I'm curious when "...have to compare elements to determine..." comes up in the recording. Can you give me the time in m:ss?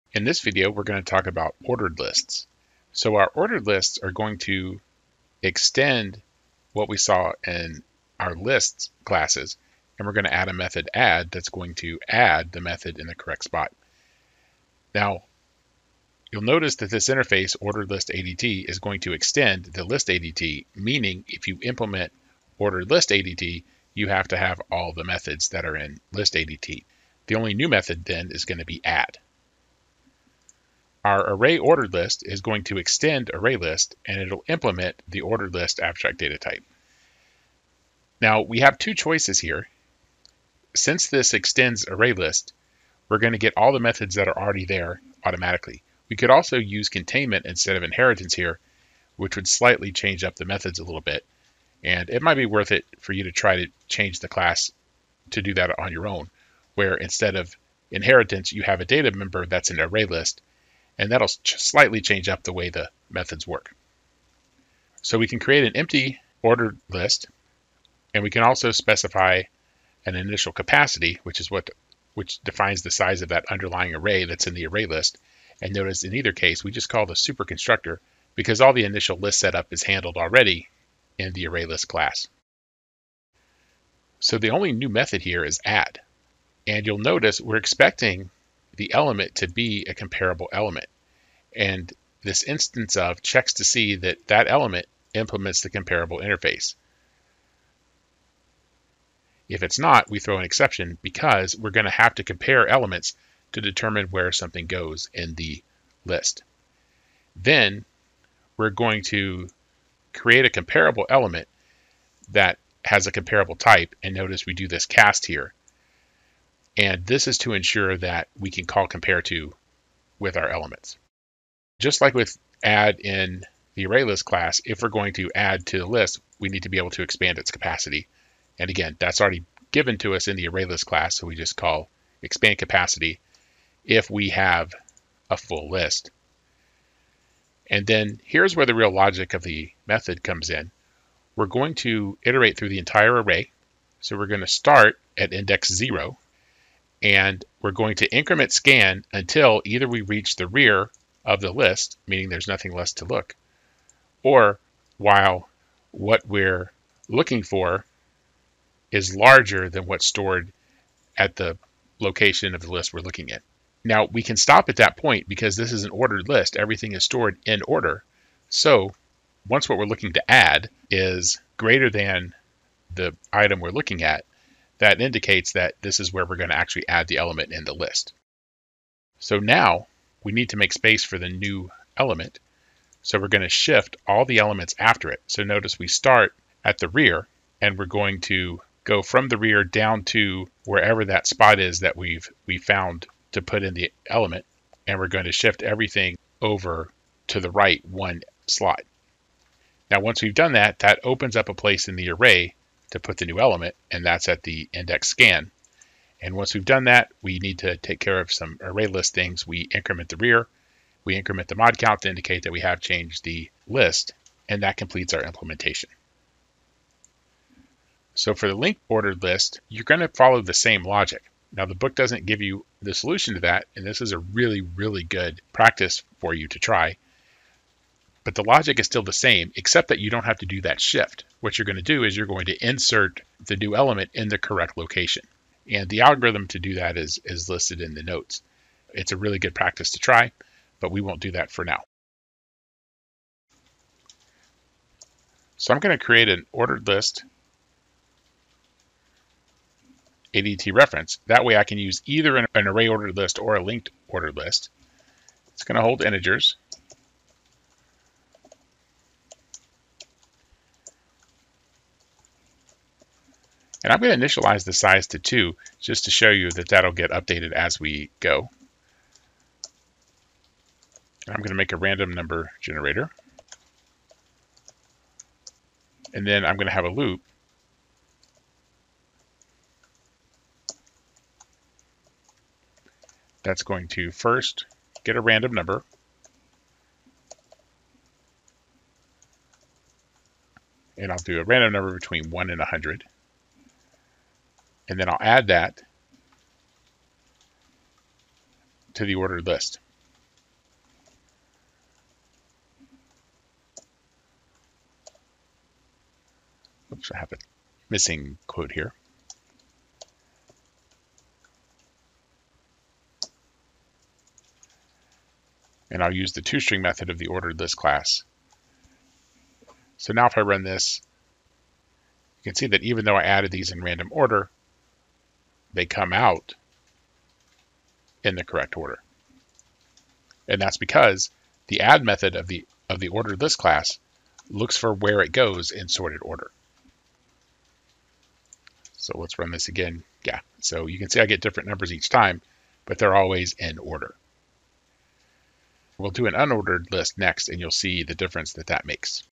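1:41.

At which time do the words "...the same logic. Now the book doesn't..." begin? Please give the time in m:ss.
3:40.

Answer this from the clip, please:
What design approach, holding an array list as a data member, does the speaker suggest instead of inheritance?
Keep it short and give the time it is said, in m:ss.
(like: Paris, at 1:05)
containment, at 0:46.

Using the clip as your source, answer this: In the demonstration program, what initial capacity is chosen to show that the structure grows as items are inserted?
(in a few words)
2.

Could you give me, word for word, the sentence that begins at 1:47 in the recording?
Then we're going to create a comparable element that has a comparable type.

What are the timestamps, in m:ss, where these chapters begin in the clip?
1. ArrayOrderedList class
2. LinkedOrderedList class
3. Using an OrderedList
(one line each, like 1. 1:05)
1. 0:30
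2. 3:37
3. 4:00.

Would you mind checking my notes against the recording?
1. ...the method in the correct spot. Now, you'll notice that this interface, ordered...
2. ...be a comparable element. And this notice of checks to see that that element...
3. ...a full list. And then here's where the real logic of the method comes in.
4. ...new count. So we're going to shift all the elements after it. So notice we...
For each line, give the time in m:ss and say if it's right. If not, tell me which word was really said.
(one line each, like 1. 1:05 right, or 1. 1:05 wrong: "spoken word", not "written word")
1. 0:12 right
2. 1:29 wrong: "instance", not "notice"
3. 2:15 right
4. 3:01 wrong: "element", not "count".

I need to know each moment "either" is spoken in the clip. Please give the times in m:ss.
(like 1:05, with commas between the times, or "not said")
1:16, 2:29, 4:12.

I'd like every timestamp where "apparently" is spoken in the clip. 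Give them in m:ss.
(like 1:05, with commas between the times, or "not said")
not said.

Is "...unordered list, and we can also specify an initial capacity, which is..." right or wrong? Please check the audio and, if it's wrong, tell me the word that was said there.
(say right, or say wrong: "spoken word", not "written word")
wrong: "ordered", not "unordered".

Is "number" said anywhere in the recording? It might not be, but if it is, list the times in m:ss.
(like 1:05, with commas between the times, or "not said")
4:32, 4:45, 4:51, 5:41.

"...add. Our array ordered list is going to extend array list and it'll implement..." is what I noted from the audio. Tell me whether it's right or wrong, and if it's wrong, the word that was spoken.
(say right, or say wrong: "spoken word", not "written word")
right.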